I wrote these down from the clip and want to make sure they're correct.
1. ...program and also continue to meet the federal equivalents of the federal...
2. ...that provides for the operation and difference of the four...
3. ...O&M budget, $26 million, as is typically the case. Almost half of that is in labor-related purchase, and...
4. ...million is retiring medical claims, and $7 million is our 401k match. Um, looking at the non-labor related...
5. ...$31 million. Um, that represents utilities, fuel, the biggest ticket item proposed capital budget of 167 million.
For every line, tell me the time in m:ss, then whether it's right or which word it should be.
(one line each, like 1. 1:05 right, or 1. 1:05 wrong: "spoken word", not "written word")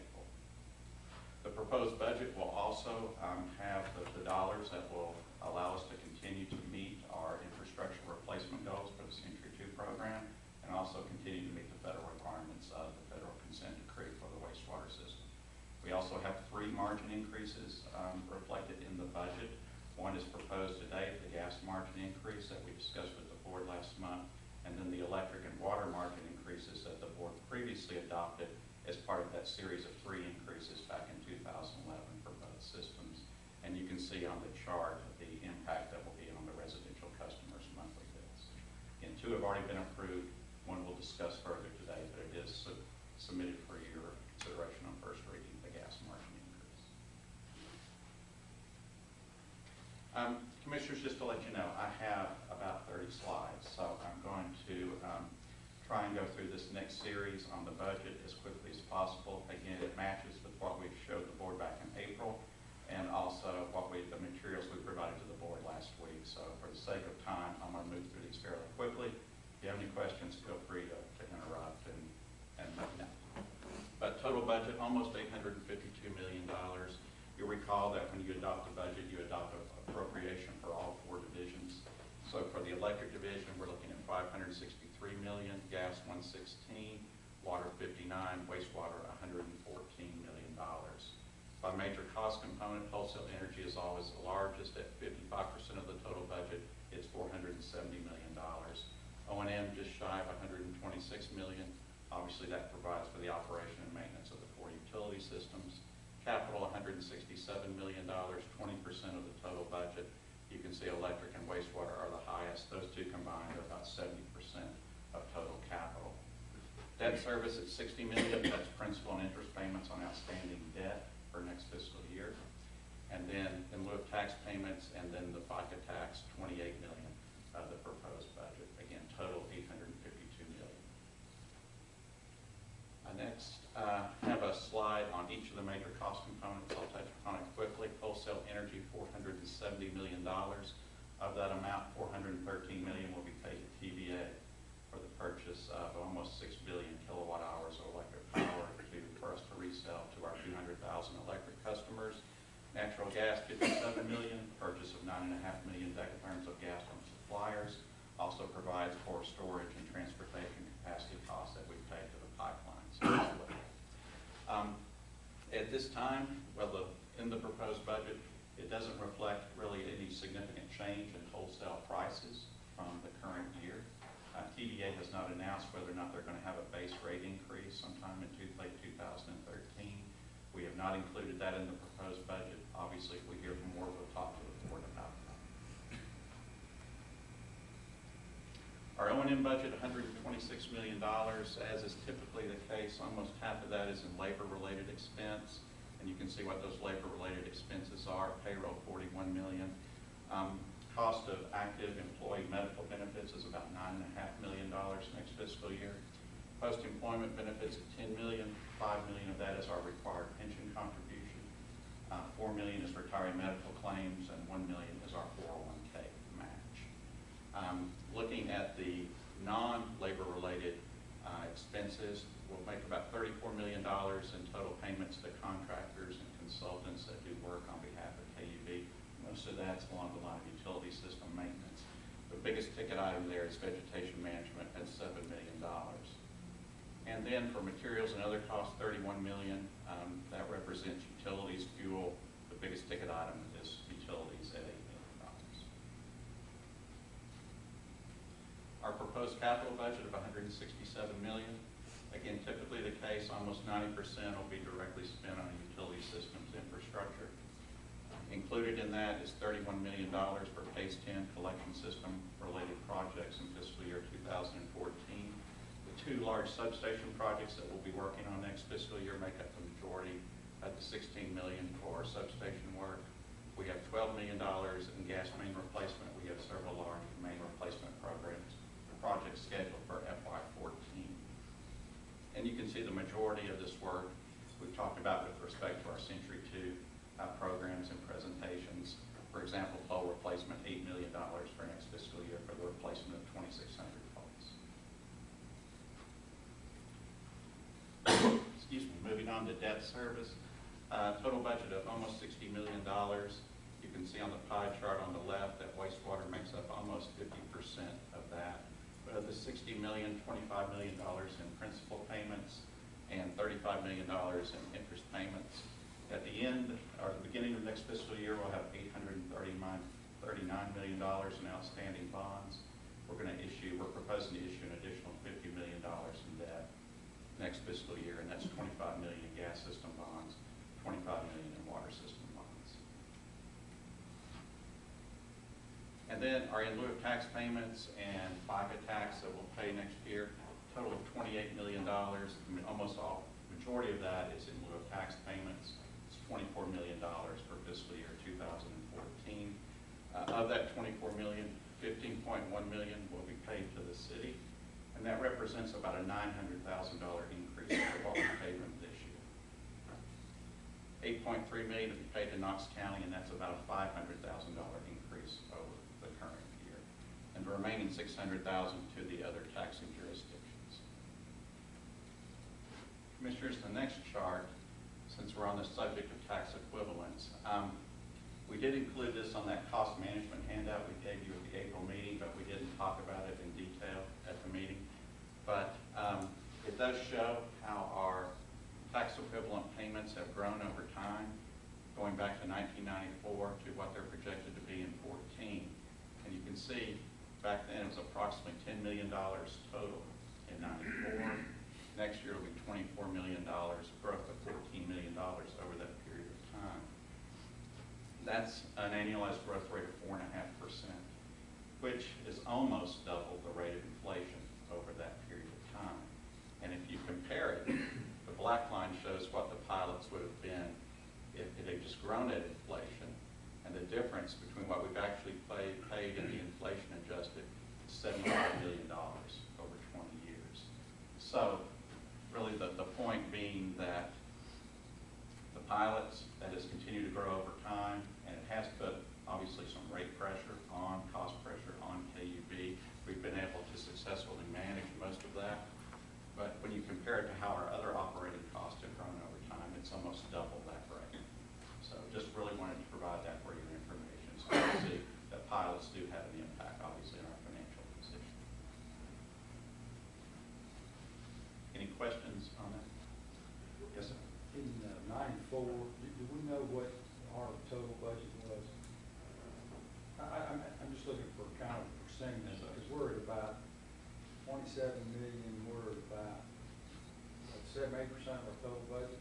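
1. 0:09 wrong: "requirements", not "equivalents"
2. 1:42 wrong: "maintenance", not "difference"
3. 3:09 wrong: "expense", not "purchase"
4. 3:32 wrong: "1", not "7"
5. 3:58 right.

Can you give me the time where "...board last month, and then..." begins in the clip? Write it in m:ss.
0:23.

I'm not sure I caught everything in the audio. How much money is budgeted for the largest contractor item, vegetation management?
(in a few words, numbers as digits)
$7 million.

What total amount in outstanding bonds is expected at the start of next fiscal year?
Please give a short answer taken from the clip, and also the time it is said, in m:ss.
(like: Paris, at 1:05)
$839 million, at 5:18.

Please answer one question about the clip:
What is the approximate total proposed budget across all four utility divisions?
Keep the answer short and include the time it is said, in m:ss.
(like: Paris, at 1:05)
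$852 million, at 1:14.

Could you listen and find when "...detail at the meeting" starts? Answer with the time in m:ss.
6:23.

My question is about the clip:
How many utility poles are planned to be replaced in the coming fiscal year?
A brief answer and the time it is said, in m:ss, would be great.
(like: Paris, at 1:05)
2,600, at 4:53.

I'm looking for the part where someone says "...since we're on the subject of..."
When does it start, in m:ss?
6:15.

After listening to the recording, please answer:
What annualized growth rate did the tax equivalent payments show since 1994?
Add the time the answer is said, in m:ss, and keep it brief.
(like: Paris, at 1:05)
4.5%, at 6:50.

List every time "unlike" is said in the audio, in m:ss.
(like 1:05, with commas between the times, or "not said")
not said.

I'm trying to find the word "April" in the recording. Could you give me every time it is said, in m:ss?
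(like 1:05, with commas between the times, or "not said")
1:01, 6:21.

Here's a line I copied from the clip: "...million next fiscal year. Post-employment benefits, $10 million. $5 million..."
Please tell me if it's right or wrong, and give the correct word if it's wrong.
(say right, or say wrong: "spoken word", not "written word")
right.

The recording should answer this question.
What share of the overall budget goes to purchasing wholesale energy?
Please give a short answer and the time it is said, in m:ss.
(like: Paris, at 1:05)
55%, at 1:35.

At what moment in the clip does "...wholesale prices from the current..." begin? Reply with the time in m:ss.
2:51.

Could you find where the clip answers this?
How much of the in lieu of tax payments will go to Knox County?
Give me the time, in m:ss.
6:01.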